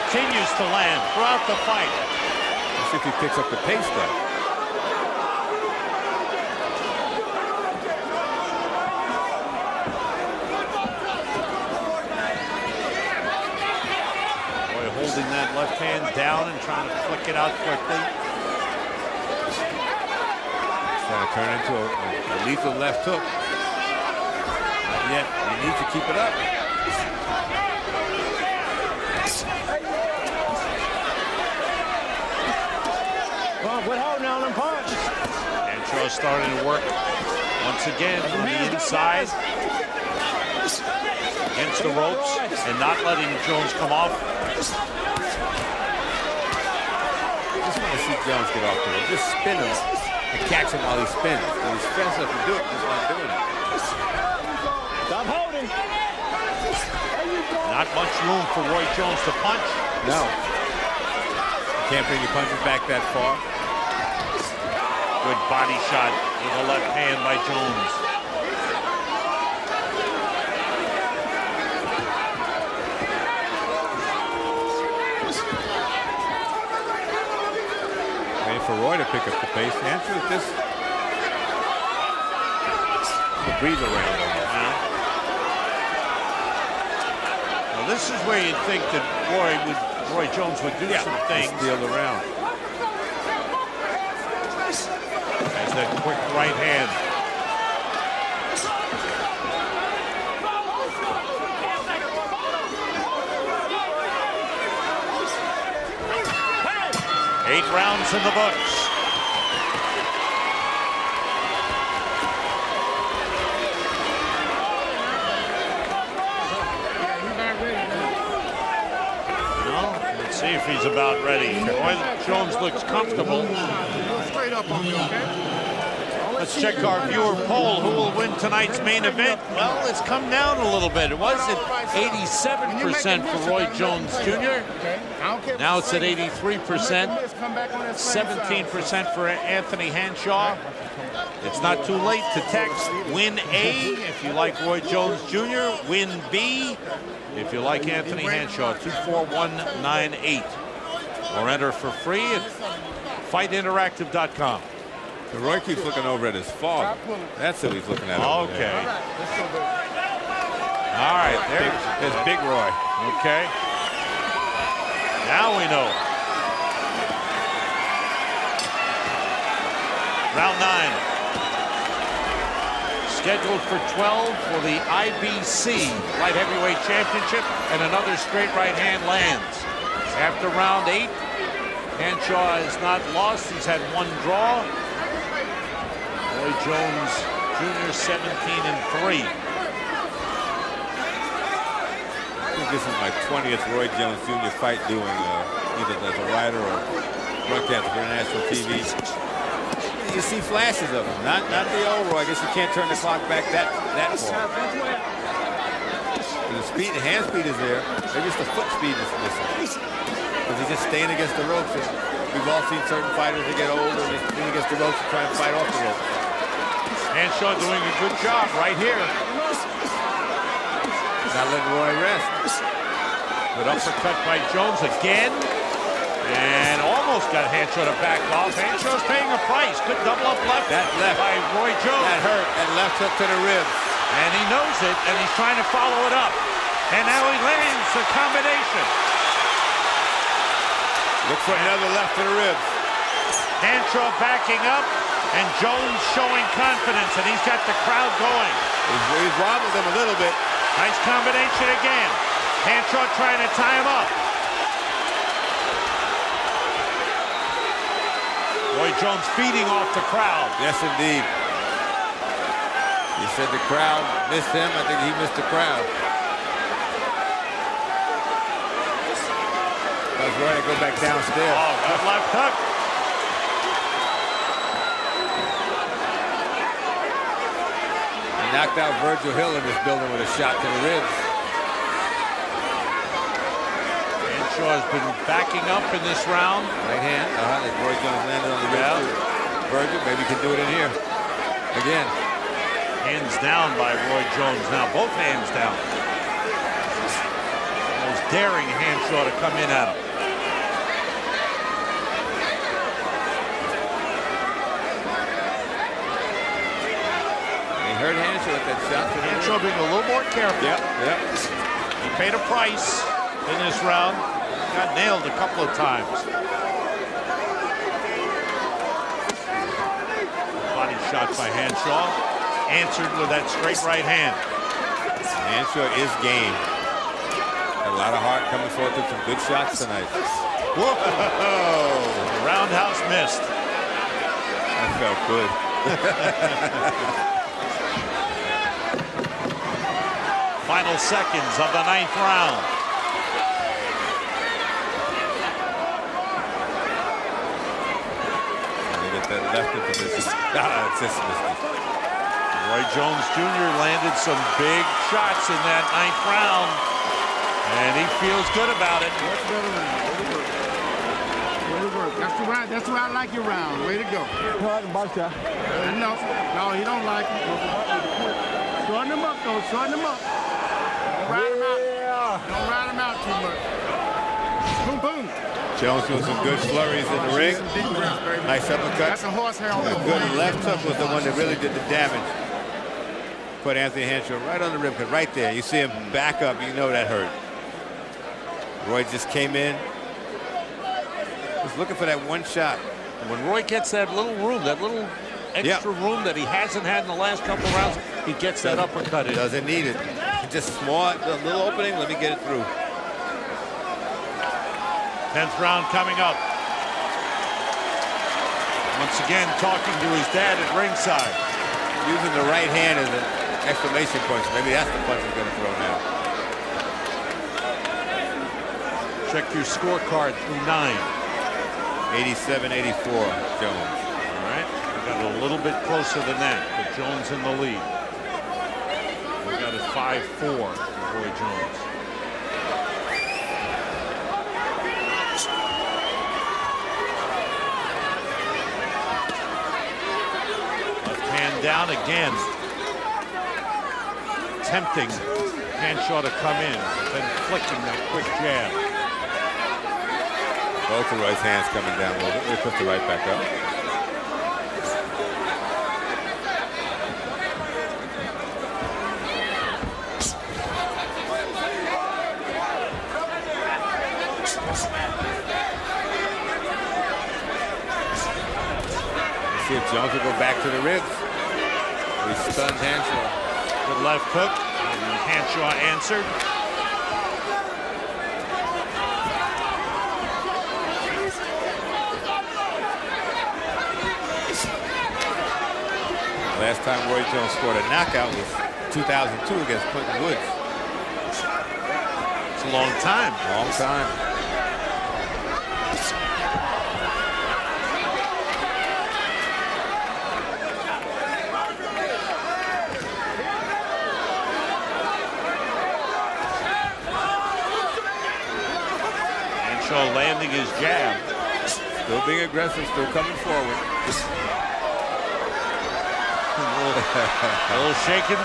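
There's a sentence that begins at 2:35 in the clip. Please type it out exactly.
The Roy keeps looking over at his father.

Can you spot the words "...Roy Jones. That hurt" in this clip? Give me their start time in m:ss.
3:51.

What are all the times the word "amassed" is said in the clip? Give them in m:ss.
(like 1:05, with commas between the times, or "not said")
not said.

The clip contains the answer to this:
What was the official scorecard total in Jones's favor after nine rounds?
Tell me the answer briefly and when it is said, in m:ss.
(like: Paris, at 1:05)
87-84, at 7:02.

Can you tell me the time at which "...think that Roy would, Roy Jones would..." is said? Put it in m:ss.
1:28.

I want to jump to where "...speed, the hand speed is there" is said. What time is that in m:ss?
3:26.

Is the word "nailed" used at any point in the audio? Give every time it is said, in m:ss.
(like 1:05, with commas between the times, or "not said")
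5:14.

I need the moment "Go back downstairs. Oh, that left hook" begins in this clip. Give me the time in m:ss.
4:30.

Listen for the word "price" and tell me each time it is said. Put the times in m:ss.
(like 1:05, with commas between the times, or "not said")
3:49, 5:12.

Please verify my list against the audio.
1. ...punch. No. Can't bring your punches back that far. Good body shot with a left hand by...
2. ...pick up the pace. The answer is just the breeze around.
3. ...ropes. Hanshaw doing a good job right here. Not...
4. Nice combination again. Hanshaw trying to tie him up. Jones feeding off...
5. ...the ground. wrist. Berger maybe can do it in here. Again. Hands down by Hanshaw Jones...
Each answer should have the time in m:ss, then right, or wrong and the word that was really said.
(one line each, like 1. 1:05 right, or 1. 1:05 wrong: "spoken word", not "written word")
1. 0:59 right
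2. 1:19 right
3. 3:35 right
4. 4:10 right
5. 4:48 wrong: "Roy", not "Hanshaw".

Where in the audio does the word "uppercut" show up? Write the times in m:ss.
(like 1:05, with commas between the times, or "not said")
3:43, 6:18, 6:38.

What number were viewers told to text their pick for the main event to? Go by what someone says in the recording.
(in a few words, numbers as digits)
24198.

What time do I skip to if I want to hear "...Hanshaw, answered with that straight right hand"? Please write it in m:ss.
5:21.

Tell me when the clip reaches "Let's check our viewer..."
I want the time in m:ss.
2:06.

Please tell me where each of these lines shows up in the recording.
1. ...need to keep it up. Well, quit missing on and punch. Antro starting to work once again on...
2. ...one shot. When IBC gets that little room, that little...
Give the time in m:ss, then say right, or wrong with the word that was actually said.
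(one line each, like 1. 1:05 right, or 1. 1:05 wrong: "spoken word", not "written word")
1. 0:25 wrong: "holding", not "missing"
2. 6:32 wrong: "Roy", not "IBC".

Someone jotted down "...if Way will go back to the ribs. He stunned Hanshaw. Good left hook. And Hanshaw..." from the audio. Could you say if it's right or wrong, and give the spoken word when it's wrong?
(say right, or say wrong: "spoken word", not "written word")
wrong: "Jones", not "Way".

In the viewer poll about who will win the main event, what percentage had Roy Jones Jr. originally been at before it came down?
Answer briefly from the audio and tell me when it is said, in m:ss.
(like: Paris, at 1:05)
87%, at 2:11.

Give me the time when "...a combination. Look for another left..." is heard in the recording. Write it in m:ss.
3:57.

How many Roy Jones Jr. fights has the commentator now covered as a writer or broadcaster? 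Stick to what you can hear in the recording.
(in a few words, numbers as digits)
20th.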